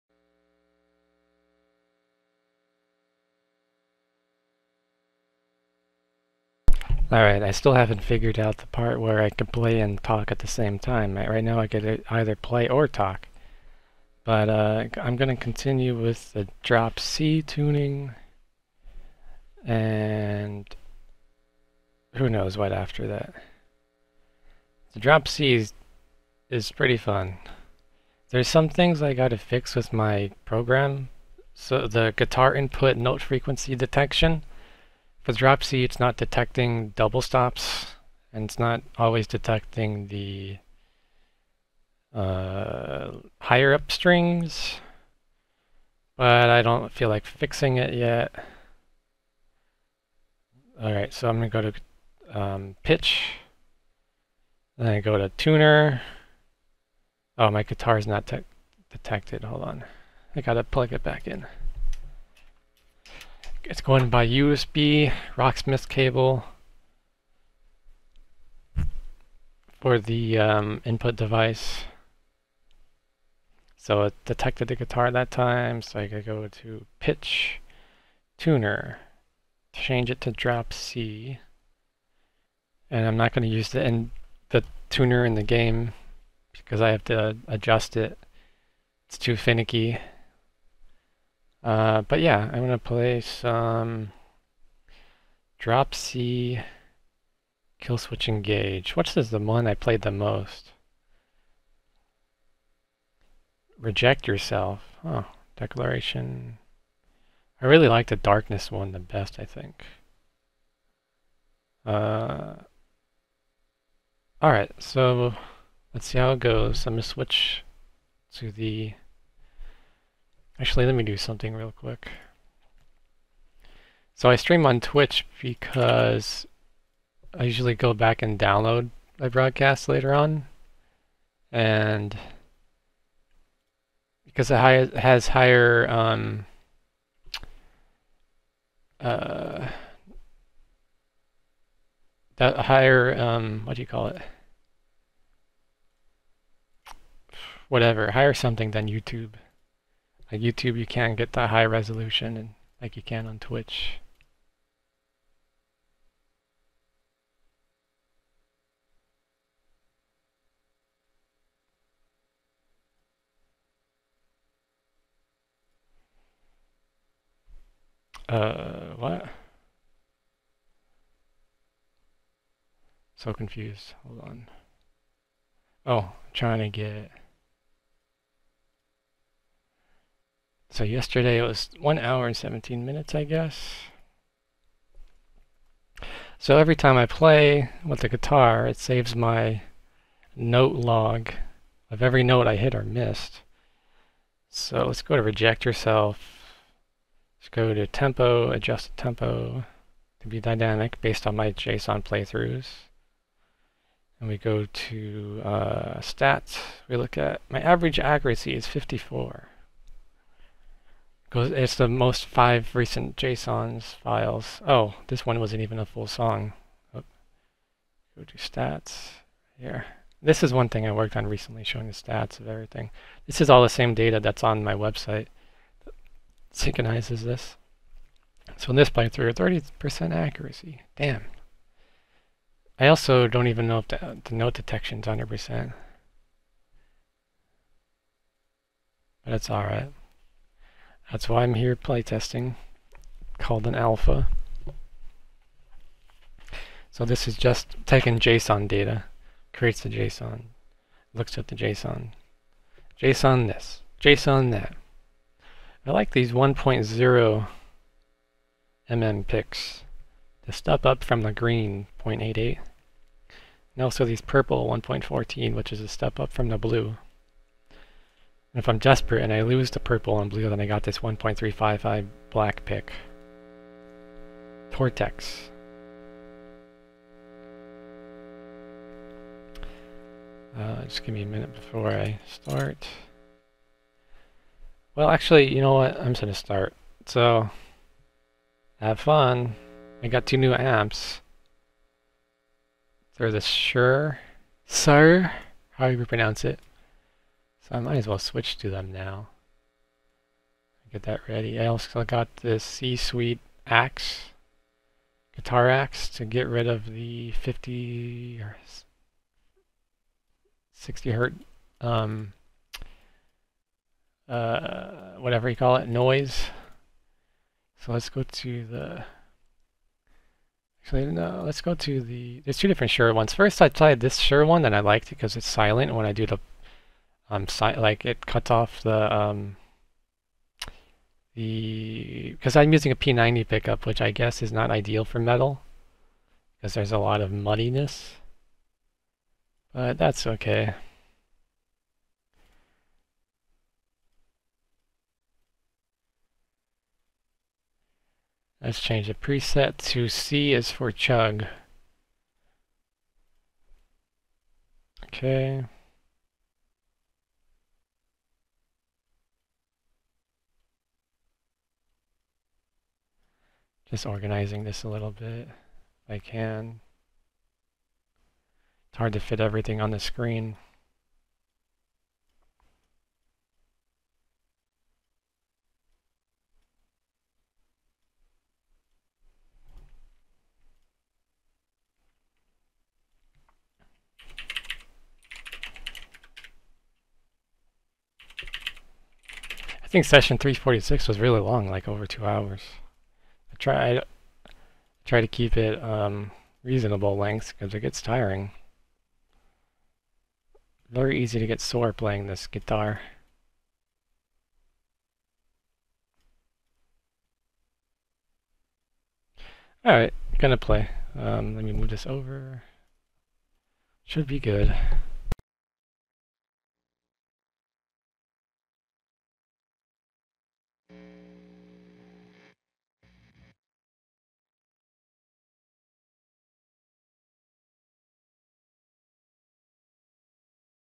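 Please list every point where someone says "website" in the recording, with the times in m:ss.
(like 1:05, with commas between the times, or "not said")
3:44.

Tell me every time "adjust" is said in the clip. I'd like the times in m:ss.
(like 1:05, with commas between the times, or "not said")
1:27, 3:18.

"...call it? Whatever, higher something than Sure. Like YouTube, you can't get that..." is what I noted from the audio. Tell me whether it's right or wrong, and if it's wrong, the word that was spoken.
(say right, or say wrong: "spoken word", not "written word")
wrong: "YouTube", not "Sure".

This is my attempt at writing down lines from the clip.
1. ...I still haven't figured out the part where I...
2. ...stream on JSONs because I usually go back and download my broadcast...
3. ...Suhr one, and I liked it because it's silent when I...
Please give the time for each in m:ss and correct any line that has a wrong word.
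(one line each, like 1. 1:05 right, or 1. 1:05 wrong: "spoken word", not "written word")
1. 0:07 right
2. 2:04 wrong: "Twitch", not "JSONs"
3. 5:24 right.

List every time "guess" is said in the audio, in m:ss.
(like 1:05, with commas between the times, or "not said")
3:03, 5:34.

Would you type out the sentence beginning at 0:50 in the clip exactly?
All right, so I'm gonna go to um, pitch, then I go to tuner.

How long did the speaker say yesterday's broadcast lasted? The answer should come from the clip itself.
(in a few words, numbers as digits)
1 hour 17 minutes.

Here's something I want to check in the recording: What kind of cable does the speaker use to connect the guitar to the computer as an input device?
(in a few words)
USB Rocksmith cable.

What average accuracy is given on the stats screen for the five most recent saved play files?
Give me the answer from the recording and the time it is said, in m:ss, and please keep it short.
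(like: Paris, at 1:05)
54, at 3:28.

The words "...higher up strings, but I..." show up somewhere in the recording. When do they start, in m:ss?
0:43.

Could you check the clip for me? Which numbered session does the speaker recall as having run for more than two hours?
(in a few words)
346.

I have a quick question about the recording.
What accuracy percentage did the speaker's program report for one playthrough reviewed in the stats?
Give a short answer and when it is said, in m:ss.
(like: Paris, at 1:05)
30%, at 3:49.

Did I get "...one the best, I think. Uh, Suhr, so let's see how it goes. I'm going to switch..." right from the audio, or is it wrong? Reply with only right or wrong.
wrong.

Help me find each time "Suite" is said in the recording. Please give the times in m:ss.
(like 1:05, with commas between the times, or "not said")
5:02.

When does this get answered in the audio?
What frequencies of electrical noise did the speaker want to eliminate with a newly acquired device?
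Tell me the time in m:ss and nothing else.
5:07.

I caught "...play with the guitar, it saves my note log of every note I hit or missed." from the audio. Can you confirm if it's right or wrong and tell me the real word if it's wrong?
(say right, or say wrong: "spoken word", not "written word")
right.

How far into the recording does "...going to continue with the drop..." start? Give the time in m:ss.
0:15.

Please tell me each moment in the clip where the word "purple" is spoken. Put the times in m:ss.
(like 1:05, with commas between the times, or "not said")
4:24, 4:29.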